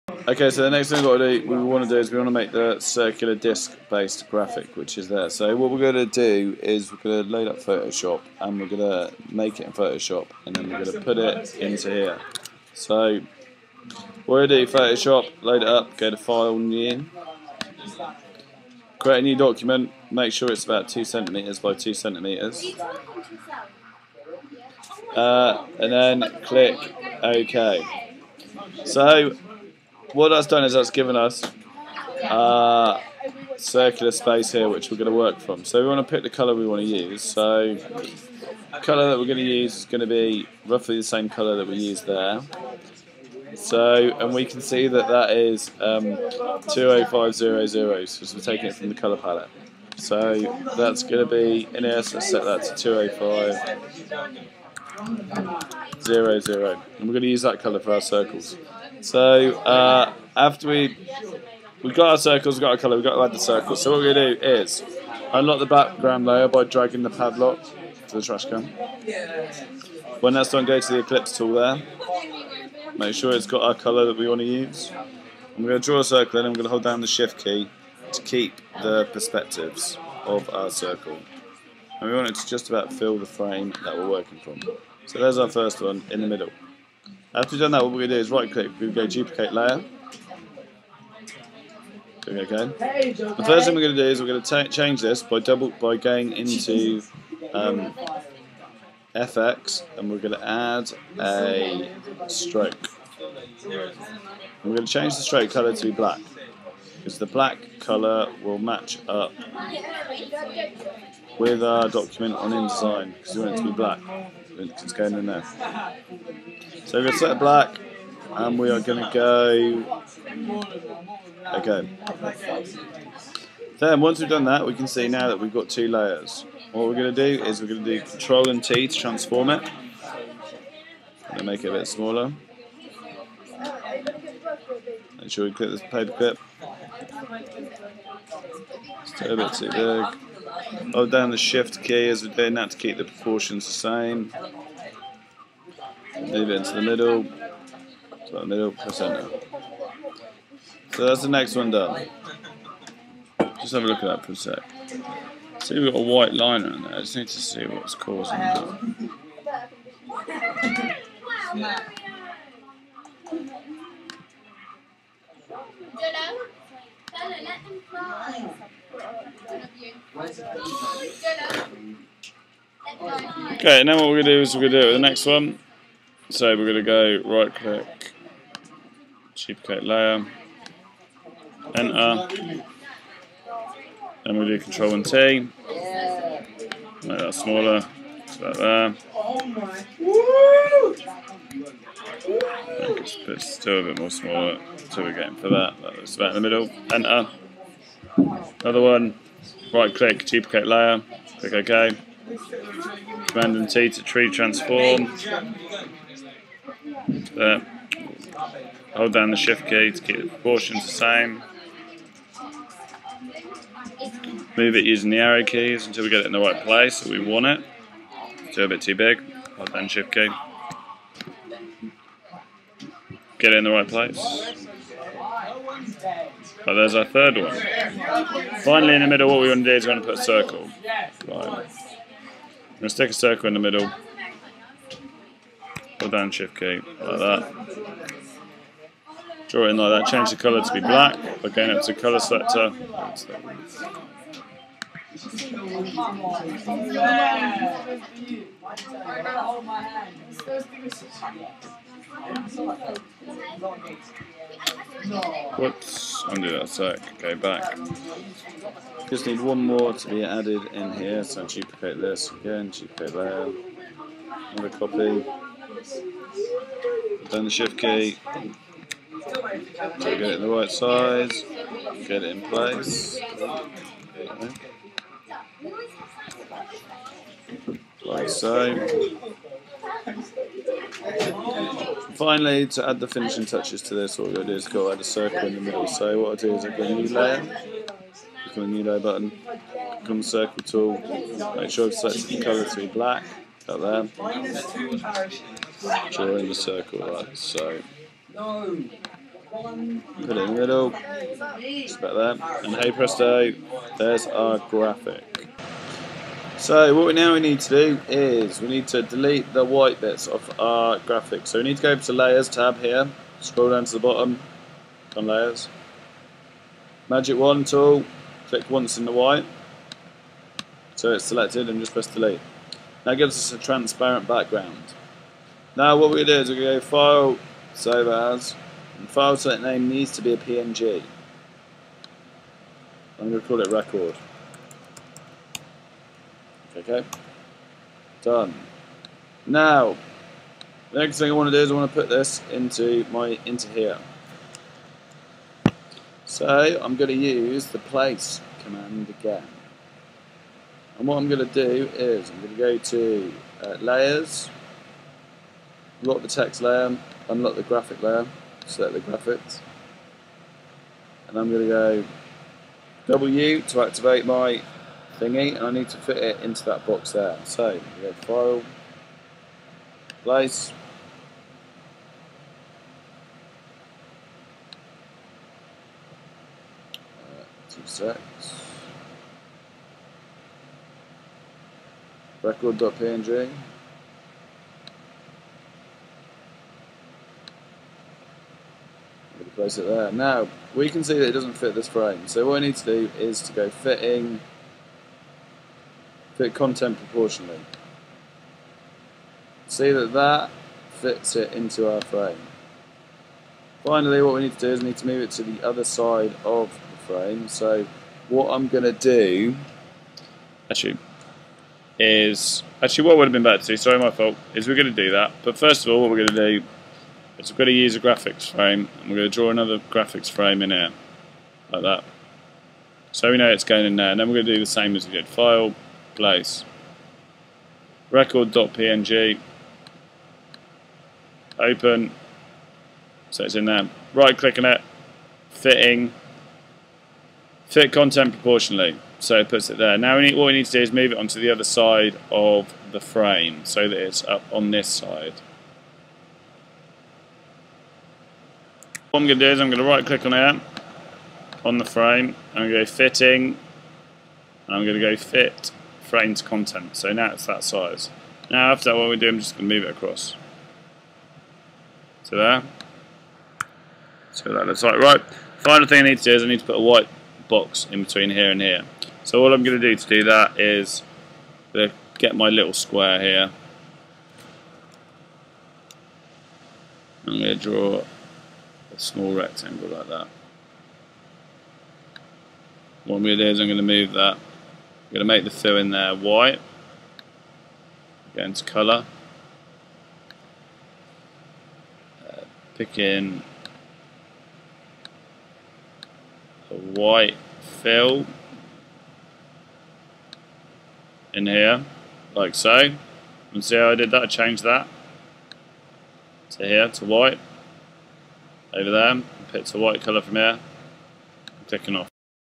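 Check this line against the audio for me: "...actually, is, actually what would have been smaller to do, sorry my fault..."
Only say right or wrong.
wrong.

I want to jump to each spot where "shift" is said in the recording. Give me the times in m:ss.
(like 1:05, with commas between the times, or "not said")
1:17, 2:21, 3:29, 3:39, 3:56, 4:27.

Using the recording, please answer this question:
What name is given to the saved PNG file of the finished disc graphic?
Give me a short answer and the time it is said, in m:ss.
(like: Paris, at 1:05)
Record, at 5:33.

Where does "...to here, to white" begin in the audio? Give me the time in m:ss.
8:26.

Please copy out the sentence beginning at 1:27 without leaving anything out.
After we have done that, what we're going to do is right click, we go duplicate layer.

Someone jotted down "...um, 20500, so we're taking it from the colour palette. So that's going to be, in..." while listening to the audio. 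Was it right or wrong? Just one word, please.
right.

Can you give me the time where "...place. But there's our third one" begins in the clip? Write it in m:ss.
3:43.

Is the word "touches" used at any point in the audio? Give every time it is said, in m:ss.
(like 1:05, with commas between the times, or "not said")
4:43.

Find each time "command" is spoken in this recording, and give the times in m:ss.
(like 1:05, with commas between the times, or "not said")
3:23, 5:48.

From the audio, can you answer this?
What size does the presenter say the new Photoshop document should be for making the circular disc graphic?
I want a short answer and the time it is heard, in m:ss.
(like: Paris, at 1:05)
2 centimeters by 2 centimeters, at 0:20.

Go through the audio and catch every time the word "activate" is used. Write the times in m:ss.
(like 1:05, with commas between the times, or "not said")
6:03.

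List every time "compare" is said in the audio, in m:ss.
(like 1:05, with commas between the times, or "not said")
not said.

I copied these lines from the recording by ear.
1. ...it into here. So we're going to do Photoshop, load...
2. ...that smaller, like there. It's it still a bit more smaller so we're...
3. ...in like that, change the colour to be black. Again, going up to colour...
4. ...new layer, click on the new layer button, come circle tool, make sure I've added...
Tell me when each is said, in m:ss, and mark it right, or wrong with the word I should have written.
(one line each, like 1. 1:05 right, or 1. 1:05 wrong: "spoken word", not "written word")
1. 0:11 right
2. 3:07 right
3. 3:59 right
4. 4:46 wrong: "selected", not "added".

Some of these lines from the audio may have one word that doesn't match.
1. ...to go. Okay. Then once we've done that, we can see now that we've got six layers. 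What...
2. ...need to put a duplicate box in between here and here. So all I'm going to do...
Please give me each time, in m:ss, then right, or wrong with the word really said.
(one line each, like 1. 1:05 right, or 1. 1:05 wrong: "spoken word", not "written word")
1. 1:59 wrong: "two", not "six"
2. 7:46 wrong: "white", not "duplicate".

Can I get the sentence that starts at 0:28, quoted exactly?
So what that's done is that's given us uh, circular space here which we're going to work from.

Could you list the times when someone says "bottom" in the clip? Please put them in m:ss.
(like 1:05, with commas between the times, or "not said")
5:13.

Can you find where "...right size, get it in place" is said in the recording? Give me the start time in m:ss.
4:30.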